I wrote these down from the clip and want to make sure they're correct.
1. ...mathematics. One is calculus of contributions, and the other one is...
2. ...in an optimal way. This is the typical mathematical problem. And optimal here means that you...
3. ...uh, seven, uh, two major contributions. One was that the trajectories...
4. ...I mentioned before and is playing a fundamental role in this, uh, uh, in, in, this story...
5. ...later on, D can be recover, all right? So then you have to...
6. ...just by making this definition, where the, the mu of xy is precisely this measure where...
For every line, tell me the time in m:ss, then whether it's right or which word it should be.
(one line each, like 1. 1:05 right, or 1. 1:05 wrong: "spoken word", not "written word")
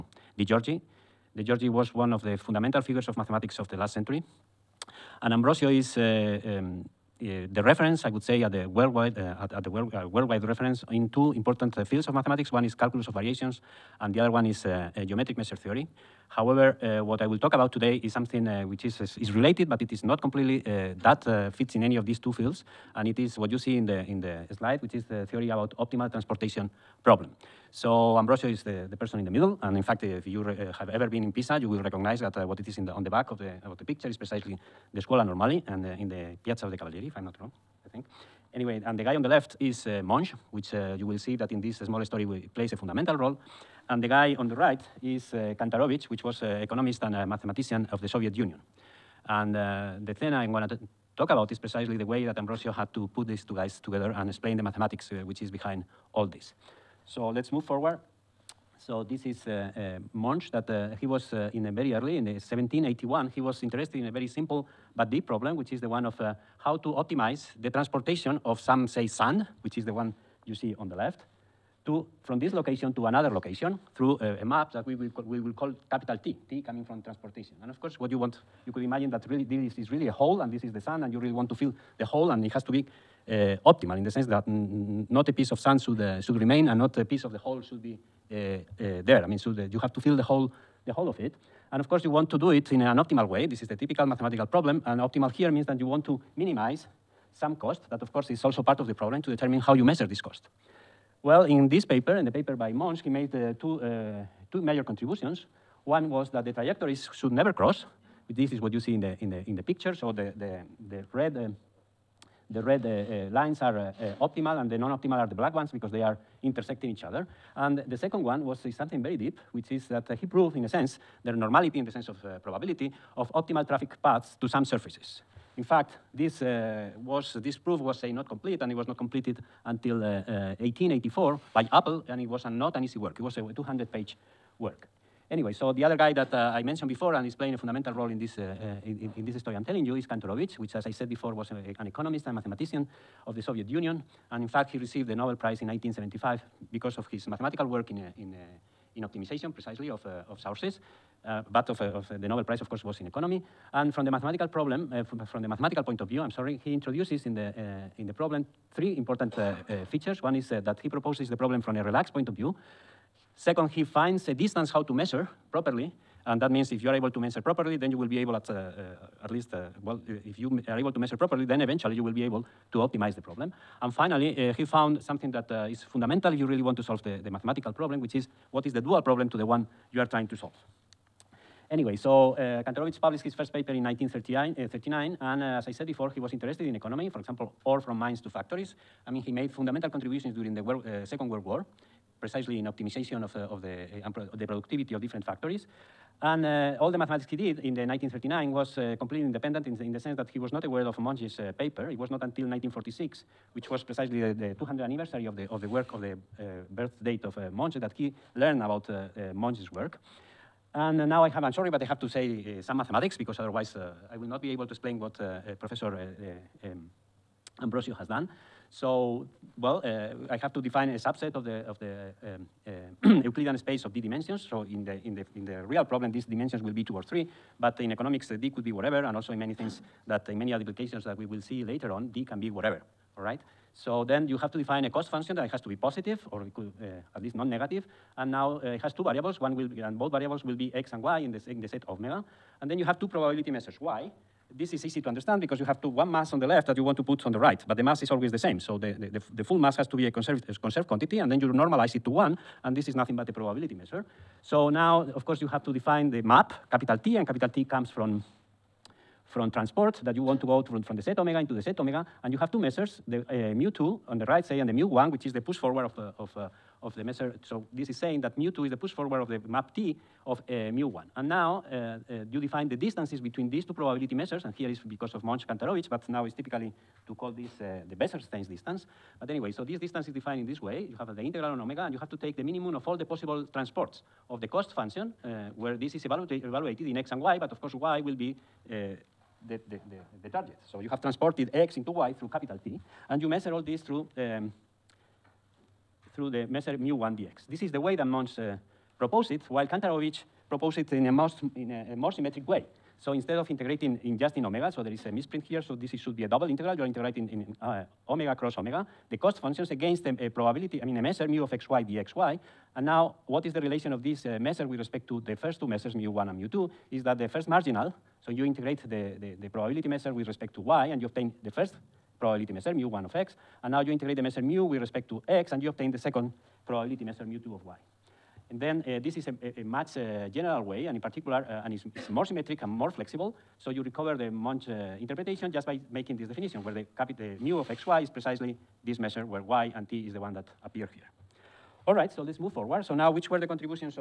1. 0:12 wrong: "variations", not "contributions"
2. 1:32 right
3. 1:43 wrong: "two", not "seven"
4. 2:16 right
5. 3:51 wrong: "whatever", not "recover"
6. 5:35 right.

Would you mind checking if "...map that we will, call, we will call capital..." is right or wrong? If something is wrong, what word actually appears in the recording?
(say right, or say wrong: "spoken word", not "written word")
right.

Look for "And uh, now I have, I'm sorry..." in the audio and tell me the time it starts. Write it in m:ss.
3:30.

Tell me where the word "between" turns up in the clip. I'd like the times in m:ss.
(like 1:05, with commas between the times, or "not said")
4:33.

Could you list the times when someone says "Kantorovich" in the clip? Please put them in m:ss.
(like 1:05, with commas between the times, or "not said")
0:45, 2:20, 3:02, 4:35, 4:59.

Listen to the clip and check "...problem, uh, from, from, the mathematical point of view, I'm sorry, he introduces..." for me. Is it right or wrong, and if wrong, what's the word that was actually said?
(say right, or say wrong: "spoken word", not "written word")
right.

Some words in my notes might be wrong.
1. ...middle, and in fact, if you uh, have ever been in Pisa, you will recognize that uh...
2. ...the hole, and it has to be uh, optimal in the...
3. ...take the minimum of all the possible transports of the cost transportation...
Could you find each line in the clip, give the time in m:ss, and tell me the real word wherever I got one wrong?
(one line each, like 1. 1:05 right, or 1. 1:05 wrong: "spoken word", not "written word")
1. 0:29 right
2. 1:21 right
3. 4:42 wrong: "function", not "transportation".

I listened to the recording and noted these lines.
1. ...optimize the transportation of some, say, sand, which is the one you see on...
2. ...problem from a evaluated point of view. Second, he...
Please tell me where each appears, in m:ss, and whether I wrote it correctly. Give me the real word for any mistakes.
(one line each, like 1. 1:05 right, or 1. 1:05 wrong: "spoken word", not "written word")
1. 1:06 right
2. 2:41 wrong: "relaxed", not "evaluated".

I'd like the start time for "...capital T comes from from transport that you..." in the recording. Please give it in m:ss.
4:17.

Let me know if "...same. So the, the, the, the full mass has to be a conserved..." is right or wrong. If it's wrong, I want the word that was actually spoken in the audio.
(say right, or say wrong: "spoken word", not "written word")
right.